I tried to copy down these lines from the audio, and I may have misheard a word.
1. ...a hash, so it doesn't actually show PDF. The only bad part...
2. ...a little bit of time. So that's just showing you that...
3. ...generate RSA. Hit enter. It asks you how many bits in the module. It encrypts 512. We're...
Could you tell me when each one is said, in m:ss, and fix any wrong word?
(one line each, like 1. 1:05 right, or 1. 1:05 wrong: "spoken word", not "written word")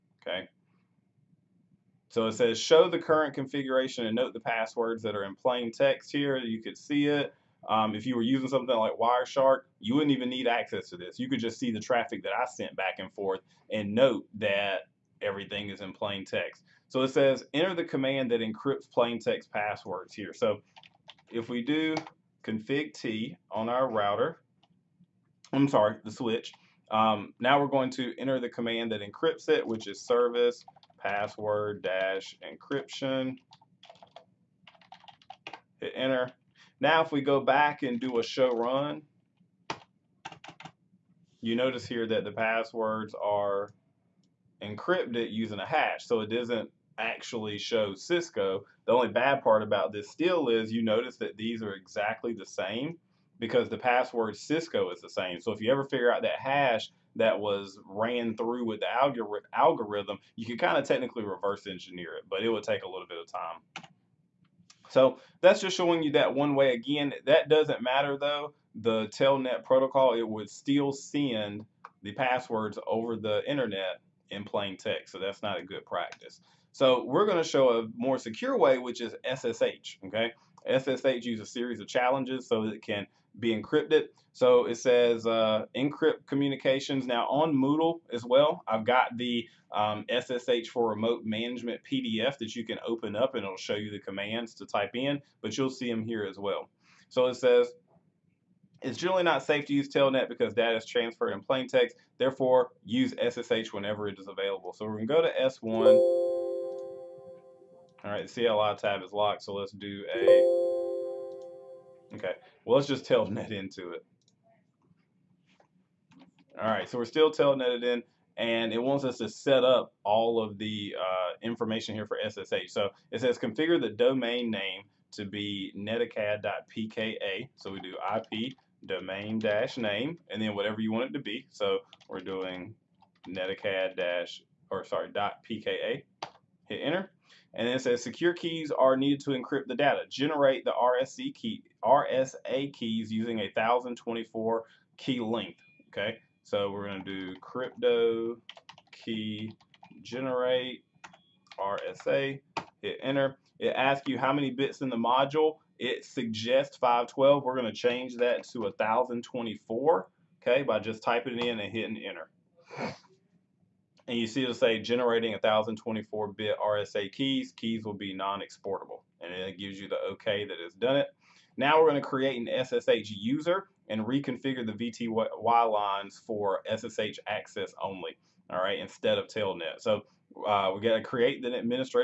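1. 0:45 wrong: "Cisco", not "PDF"
2. 1:02 right
3. 2:30 wrong: "suggests", not "encrypts".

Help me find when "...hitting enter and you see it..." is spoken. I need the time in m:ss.
2:41.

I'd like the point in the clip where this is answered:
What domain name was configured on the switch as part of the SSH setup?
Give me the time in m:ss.
2:05.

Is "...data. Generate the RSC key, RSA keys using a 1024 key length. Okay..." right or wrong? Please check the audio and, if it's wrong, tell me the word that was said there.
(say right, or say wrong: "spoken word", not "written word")
right.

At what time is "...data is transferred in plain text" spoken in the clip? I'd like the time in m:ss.
1:40.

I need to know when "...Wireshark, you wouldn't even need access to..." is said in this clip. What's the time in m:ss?
0:08.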